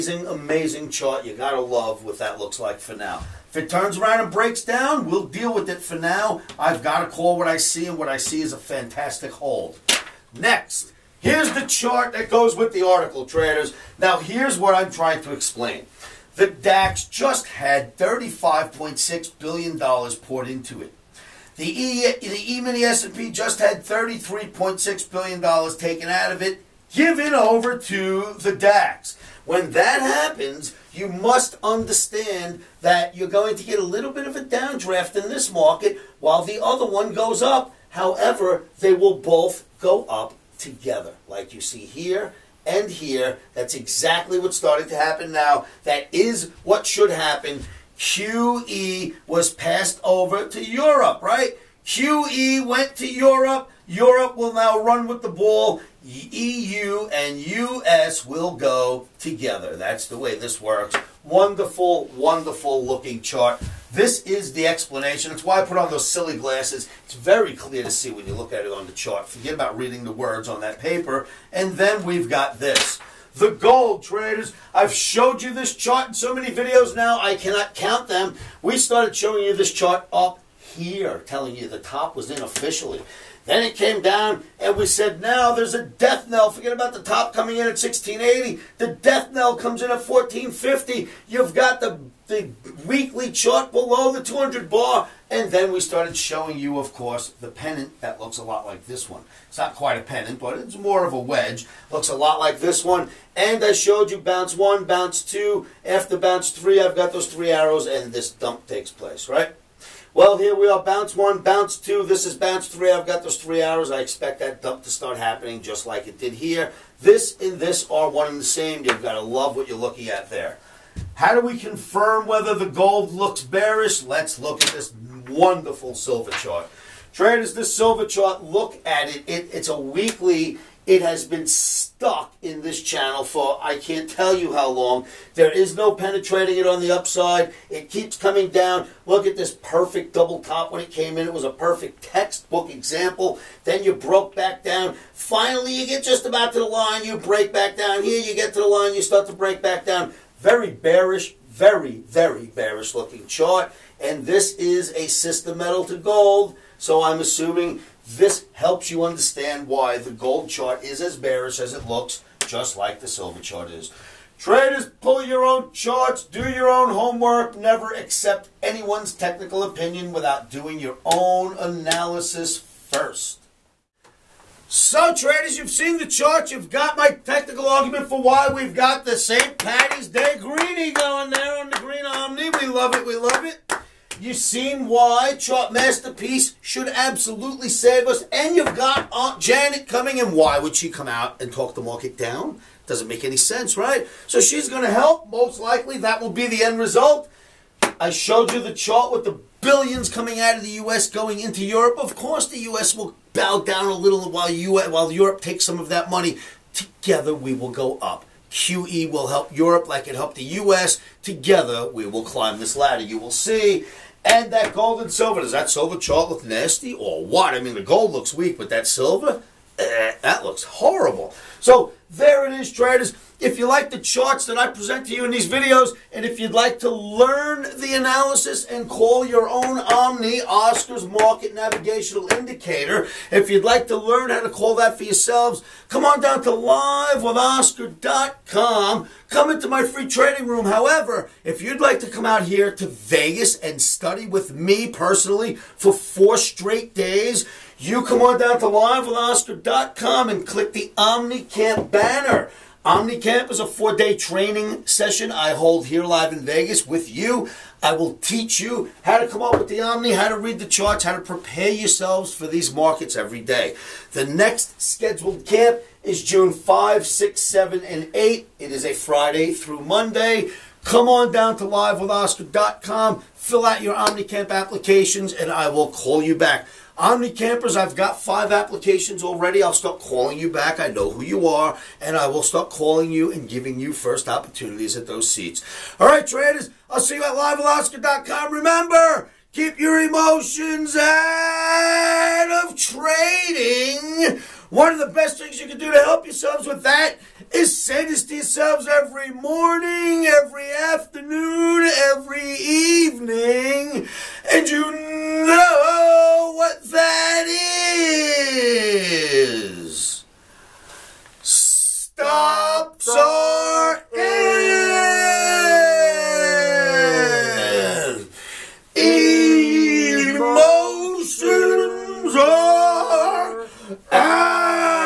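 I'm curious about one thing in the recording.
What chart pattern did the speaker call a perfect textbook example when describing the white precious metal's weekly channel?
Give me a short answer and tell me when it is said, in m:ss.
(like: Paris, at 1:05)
double top, at 2:20.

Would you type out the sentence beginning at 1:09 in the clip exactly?
Forget about reading the words on that paper.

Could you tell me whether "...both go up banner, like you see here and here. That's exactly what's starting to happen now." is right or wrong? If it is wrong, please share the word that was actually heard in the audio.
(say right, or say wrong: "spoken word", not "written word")
wrong: "together", not "banner".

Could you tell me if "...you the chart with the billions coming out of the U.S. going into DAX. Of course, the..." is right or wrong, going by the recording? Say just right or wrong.
wrong.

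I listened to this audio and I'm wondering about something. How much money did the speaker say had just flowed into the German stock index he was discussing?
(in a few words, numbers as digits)
$35.6 billion.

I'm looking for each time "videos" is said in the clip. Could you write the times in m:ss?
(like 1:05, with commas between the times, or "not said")
1:16, 3:45.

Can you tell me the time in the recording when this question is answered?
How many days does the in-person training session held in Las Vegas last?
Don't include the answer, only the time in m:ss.
4:13.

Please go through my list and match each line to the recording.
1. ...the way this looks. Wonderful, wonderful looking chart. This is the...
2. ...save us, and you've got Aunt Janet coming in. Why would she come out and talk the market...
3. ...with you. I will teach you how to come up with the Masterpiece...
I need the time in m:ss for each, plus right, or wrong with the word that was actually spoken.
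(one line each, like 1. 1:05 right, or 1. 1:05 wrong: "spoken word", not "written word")
1. 1:00 wrong: "works", not "looks"
2. 3:07 right
3. 4:16 wrong: "Omni", not "Masterpiece".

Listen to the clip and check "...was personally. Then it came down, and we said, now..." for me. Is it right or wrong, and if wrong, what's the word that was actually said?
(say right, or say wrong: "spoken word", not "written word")
wrong: "unofficially", not "personally".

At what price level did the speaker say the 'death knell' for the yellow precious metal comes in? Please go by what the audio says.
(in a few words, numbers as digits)
1450.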